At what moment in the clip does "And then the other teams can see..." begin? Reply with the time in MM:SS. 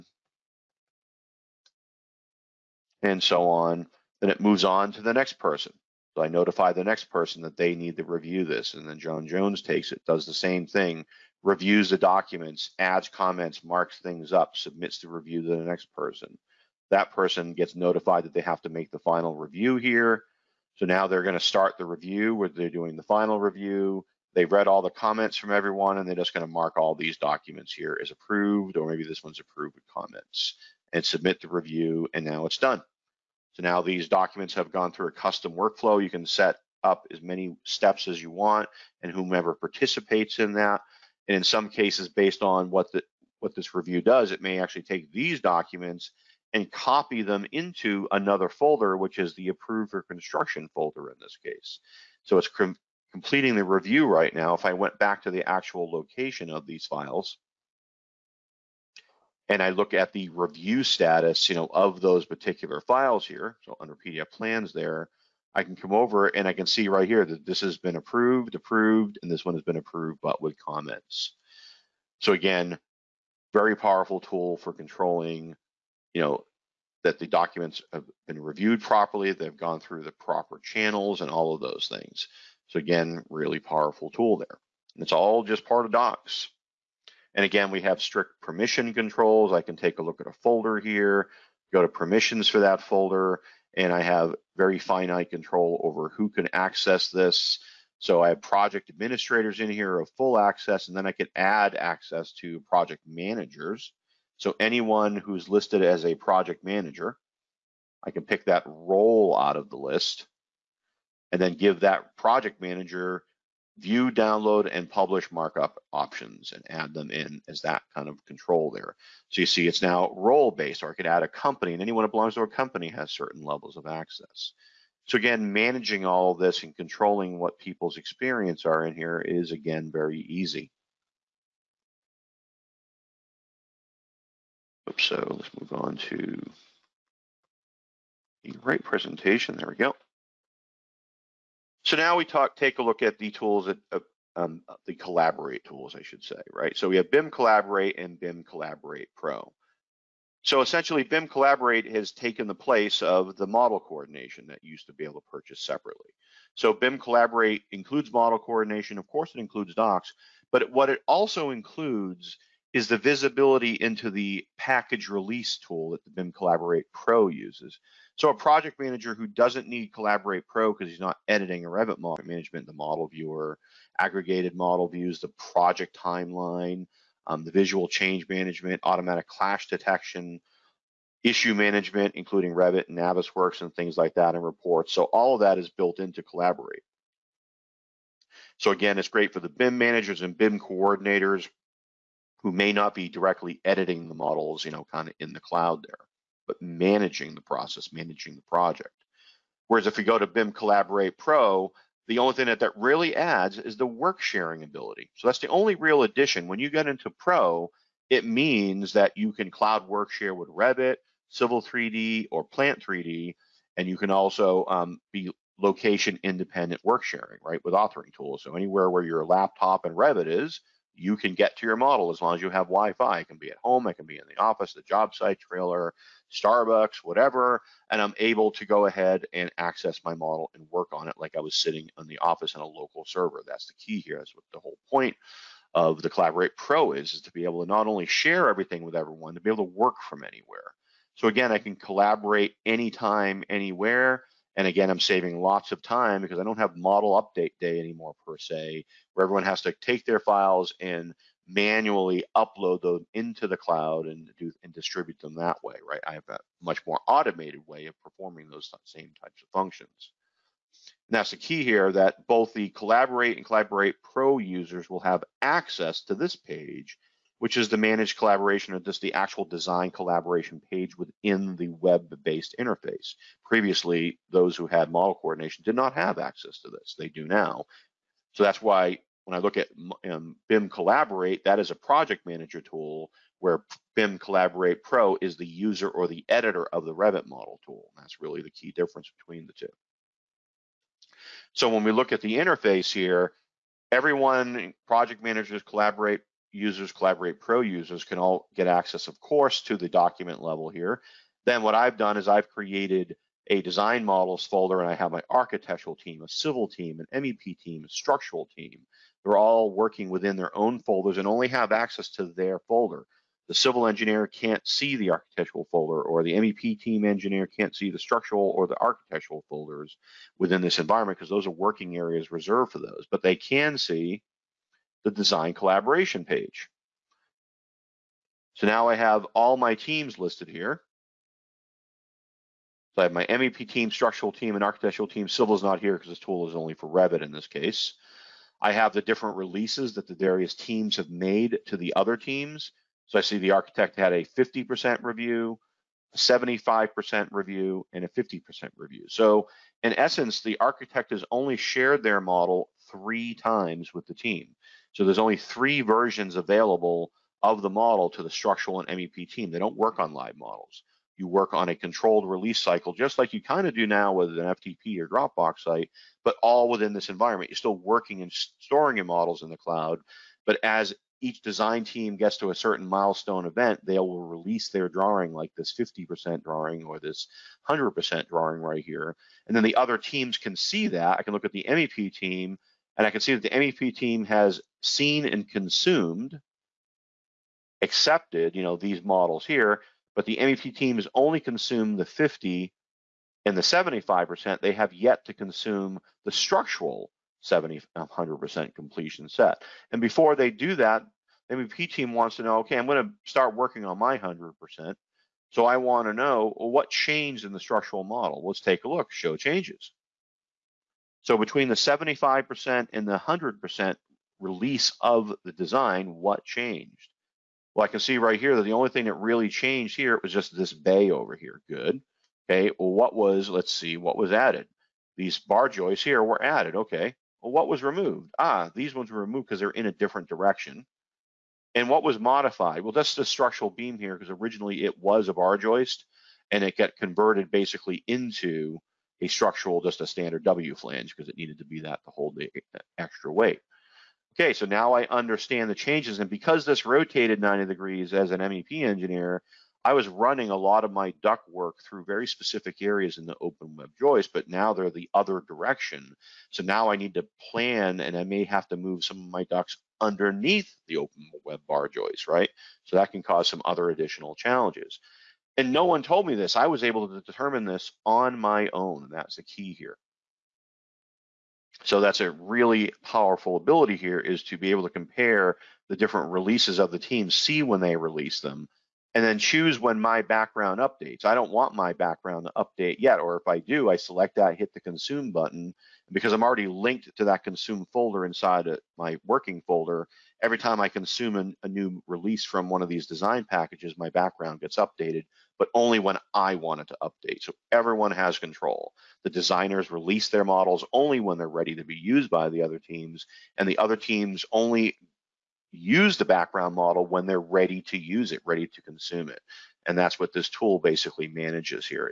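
06:19.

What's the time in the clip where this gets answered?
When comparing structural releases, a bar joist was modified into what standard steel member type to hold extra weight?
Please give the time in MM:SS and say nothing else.
07:20.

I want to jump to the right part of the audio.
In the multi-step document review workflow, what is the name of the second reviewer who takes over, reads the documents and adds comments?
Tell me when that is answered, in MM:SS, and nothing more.
00:08.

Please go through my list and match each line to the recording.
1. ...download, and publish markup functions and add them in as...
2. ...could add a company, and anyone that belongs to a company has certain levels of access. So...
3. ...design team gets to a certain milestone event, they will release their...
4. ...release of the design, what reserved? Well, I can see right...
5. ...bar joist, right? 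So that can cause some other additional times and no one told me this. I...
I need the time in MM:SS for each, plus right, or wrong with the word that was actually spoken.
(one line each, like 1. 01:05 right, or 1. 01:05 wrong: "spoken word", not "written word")
1. 01:54 wrong: "options", not "functions"
2. 02:00 right
3. 06:11 right
4. 06:54 wrong: "changed", not "reserved"
5. 07:41 wrong: "challenges", not "times".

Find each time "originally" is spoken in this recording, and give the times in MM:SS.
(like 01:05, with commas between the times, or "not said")
07:14.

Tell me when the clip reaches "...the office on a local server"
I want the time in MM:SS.
03:52.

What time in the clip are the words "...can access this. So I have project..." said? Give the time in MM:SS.
01:36.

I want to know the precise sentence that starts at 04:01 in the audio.
So again, I can collaborate anytime, anywhere.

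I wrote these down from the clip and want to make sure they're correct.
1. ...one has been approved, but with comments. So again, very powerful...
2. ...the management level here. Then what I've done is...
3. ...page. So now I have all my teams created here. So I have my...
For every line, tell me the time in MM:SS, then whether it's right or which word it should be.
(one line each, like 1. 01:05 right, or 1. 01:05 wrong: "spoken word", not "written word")
1. 01:09 right
2. 04:59 wrong: "document", not "management"
3. 05:26 wrong: "listed", not "created".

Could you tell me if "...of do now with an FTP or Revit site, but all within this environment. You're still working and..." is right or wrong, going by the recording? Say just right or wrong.
wrong.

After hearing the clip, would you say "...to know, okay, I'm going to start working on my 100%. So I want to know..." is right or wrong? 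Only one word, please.
right.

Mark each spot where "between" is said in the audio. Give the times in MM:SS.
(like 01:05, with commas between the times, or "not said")
04:49, 06:51.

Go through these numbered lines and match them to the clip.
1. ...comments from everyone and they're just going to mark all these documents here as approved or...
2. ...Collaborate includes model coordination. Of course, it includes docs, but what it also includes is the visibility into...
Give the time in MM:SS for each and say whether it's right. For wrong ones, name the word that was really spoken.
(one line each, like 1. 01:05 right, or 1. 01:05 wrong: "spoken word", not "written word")
1. 00:24 right
2. 02:36 right.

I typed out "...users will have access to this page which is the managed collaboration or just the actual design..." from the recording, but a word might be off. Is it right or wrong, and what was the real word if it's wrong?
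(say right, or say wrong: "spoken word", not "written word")
right.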